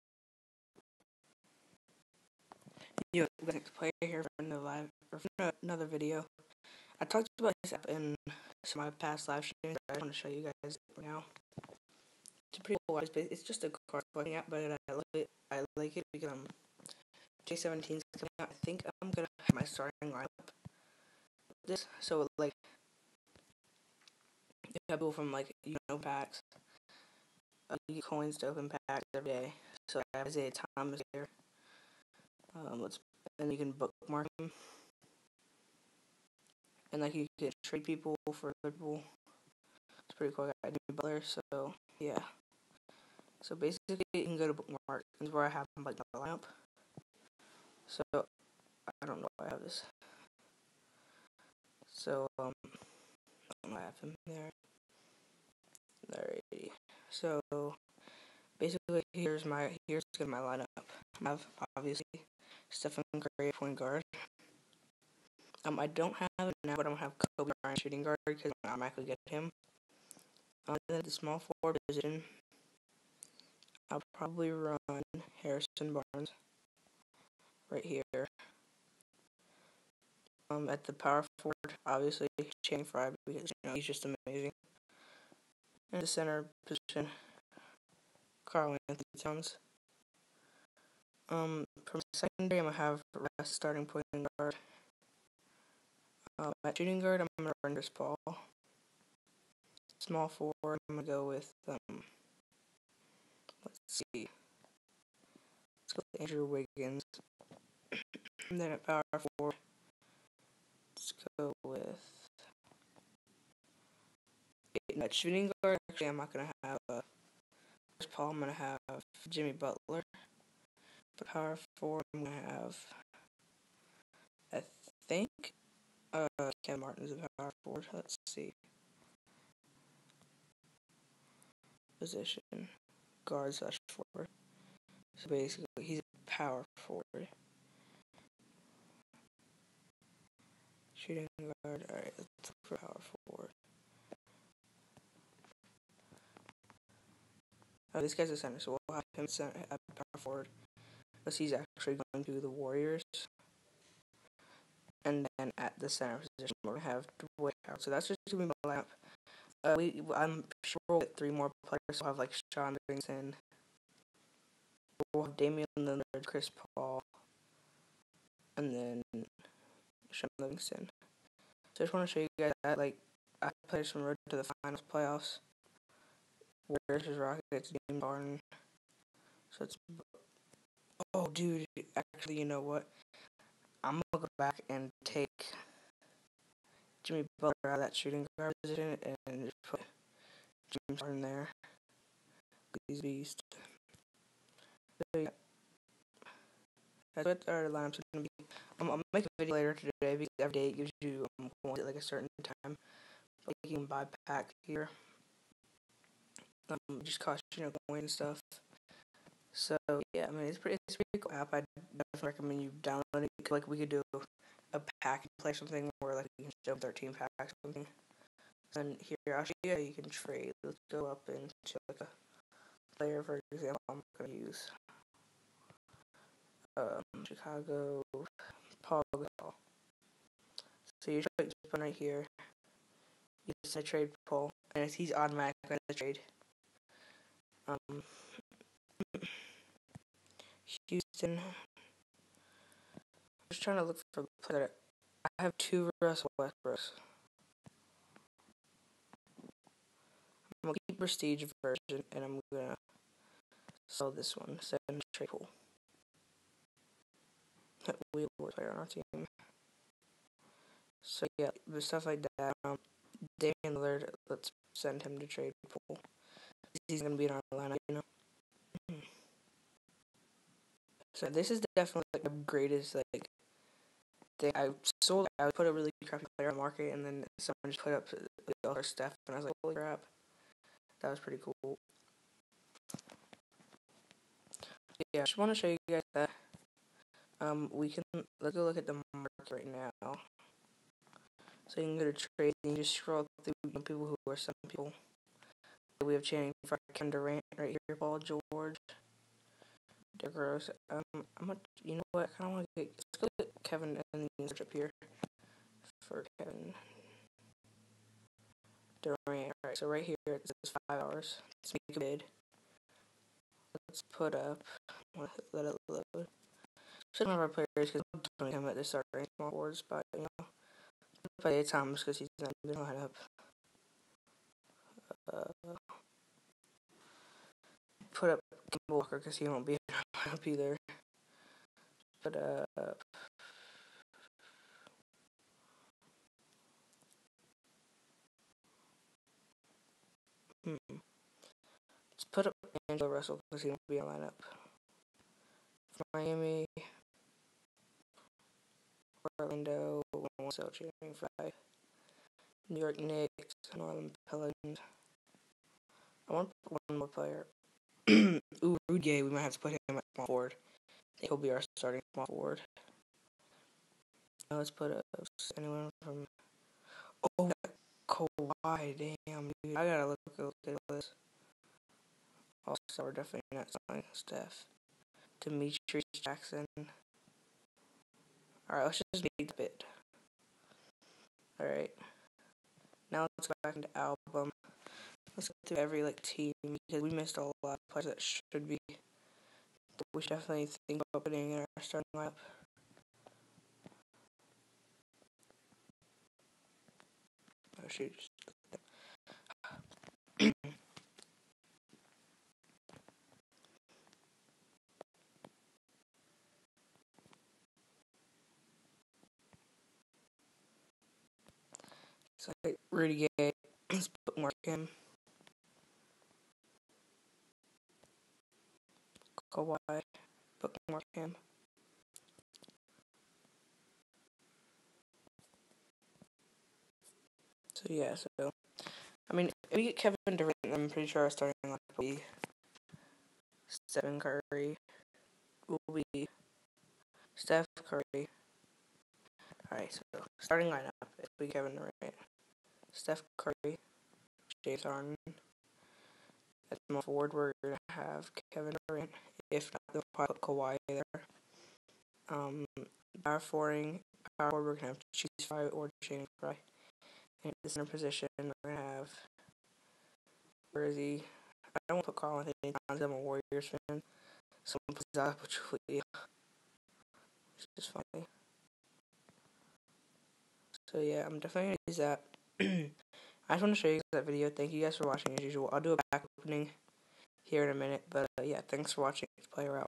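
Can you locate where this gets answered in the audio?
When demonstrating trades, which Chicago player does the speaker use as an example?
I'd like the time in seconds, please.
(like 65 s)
228 s.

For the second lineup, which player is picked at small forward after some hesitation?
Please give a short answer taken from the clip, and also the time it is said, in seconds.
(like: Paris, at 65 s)
Andrew Wiggins, at 106 s.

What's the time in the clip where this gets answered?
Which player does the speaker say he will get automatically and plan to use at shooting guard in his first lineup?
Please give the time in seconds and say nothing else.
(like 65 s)
67 s.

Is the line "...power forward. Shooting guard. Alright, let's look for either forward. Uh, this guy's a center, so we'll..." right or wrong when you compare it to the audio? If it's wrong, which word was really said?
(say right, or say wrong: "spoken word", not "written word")
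wrong: "power", not "either".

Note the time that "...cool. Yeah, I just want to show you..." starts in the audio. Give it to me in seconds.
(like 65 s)
281 s.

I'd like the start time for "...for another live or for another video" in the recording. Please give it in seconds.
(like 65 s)
4 s.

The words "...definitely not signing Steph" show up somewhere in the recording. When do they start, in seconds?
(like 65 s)
373 s.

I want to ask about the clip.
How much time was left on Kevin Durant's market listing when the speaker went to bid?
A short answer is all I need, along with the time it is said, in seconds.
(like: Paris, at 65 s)
5 hours, at 310 s.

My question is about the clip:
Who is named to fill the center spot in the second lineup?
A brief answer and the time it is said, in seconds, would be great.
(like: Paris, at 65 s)
Dwight Howard, at 157 s.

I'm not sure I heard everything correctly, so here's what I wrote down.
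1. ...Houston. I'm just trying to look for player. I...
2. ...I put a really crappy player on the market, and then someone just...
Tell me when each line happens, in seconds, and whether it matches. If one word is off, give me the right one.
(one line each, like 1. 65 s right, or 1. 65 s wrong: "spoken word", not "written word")
1. 240 s right
2. 275 s right.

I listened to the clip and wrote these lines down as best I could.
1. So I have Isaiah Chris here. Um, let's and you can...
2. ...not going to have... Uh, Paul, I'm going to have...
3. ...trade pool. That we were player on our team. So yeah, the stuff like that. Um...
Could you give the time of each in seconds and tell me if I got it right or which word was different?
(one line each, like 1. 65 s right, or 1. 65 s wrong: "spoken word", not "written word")
1. 29 s wrong: "Thomas", not "Chris"
2. 116 s right
3. 255 s right.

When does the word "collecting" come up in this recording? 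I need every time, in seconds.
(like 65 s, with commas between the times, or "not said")
14 s.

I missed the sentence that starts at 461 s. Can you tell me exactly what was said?
I don't want to put Carl Anthony Towns.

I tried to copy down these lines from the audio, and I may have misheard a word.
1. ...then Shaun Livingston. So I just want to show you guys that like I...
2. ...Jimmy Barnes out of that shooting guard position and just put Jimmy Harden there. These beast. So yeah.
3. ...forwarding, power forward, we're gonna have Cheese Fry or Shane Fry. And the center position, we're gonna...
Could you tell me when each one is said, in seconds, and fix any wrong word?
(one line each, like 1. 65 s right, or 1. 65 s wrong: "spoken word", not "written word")
1. 168 s right
2. 187 s wrong: "Butler", not "Barnes"
3. 453 s right.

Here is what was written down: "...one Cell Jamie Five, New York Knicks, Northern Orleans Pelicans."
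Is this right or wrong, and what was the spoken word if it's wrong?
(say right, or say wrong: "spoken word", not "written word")
right.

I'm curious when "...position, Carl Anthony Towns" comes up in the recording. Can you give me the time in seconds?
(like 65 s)
86 s.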